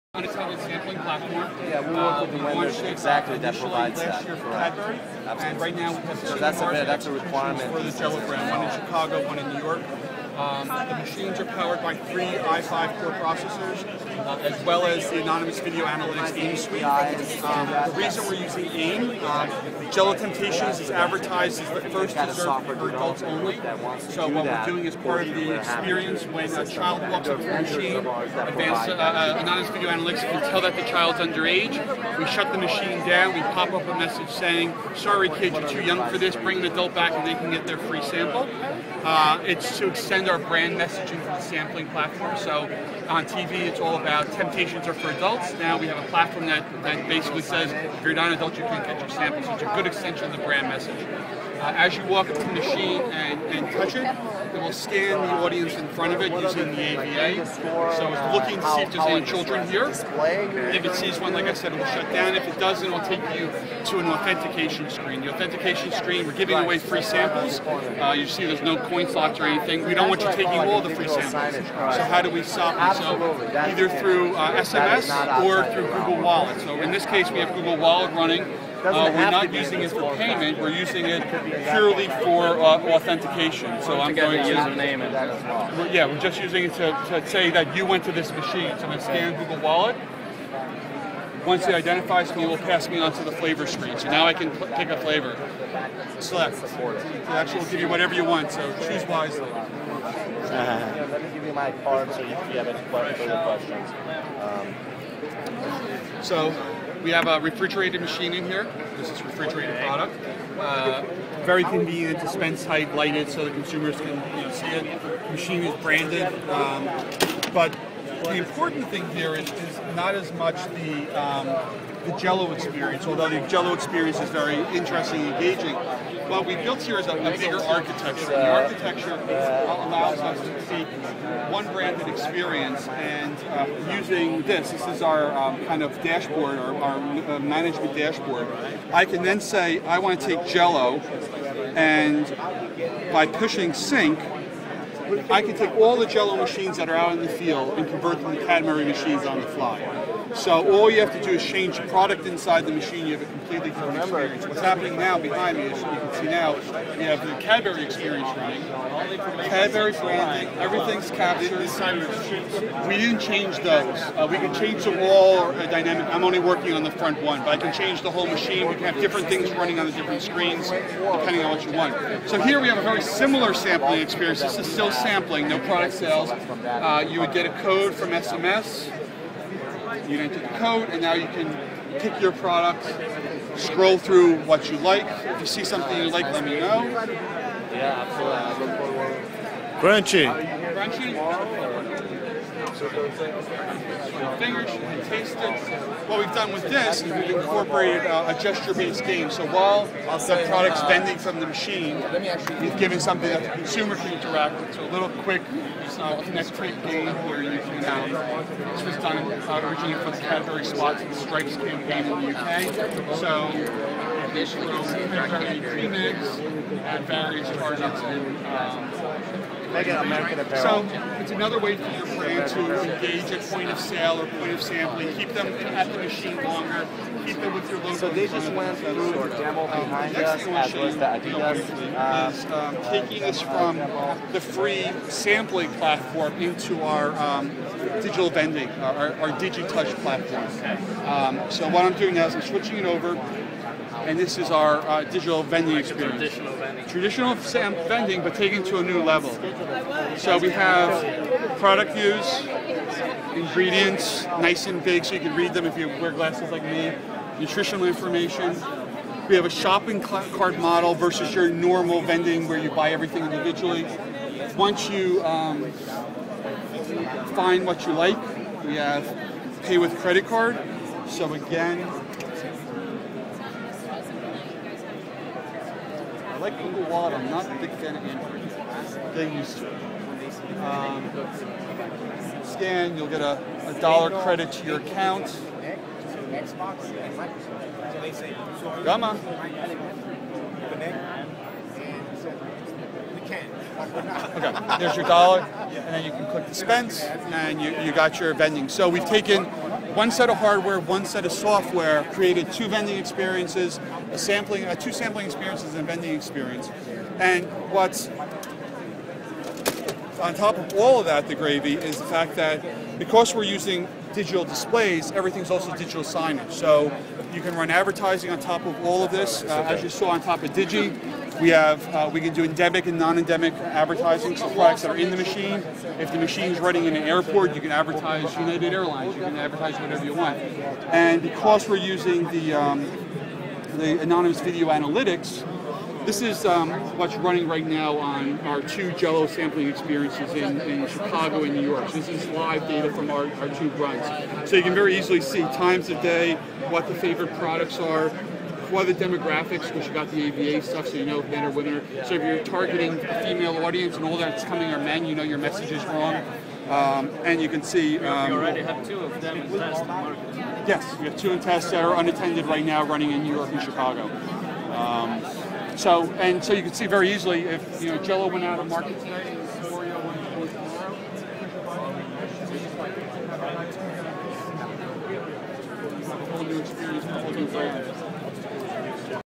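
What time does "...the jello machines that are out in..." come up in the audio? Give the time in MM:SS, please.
02:25.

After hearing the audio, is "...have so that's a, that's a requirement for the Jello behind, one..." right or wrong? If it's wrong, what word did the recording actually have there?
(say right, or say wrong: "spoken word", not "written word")
wrong: "brand", not "behind".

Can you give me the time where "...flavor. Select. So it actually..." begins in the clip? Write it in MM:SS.
01:34.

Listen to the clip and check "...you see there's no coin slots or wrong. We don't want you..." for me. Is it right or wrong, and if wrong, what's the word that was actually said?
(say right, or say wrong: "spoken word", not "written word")
wrong: "anything", not "wrong".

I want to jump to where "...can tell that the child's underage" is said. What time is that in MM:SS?
00:30.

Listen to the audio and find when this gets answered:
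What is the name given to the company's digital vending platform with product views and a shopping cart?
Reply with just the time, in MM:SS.
03:59.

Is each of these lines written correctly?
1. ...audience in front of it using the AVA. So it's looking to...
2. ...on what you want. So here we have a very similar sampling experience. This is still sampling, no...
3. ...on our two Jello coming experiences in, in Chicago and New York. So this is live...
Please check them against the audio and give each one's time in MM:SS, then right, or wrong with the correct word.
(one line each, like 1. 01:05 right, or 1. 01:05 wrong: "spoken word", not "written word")
1. 00:55 right
2. 02:51 right
3. 05:37 wrong: "sampling", not "coming".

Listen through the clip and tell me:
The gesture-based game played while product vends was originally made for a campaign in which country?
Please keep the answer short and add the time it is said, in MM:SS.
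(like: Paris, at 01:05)
UK, at 03:32.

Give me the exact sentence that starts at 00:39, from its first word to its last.
Uh, it's to extend our brand messaging for the sampling platform.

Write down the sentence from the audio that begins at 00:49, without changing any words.
It's a good extension of the brand message.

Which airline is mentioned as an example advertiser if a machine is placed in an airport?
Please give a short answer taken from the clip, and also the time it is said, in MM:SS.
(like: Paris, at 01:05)
United Airlines, at 05:28.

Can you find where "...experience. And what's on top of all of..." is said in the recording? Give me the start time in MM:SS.
05:06.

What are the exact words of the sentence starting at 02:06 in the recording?
What we built here is a, a bigger architecture.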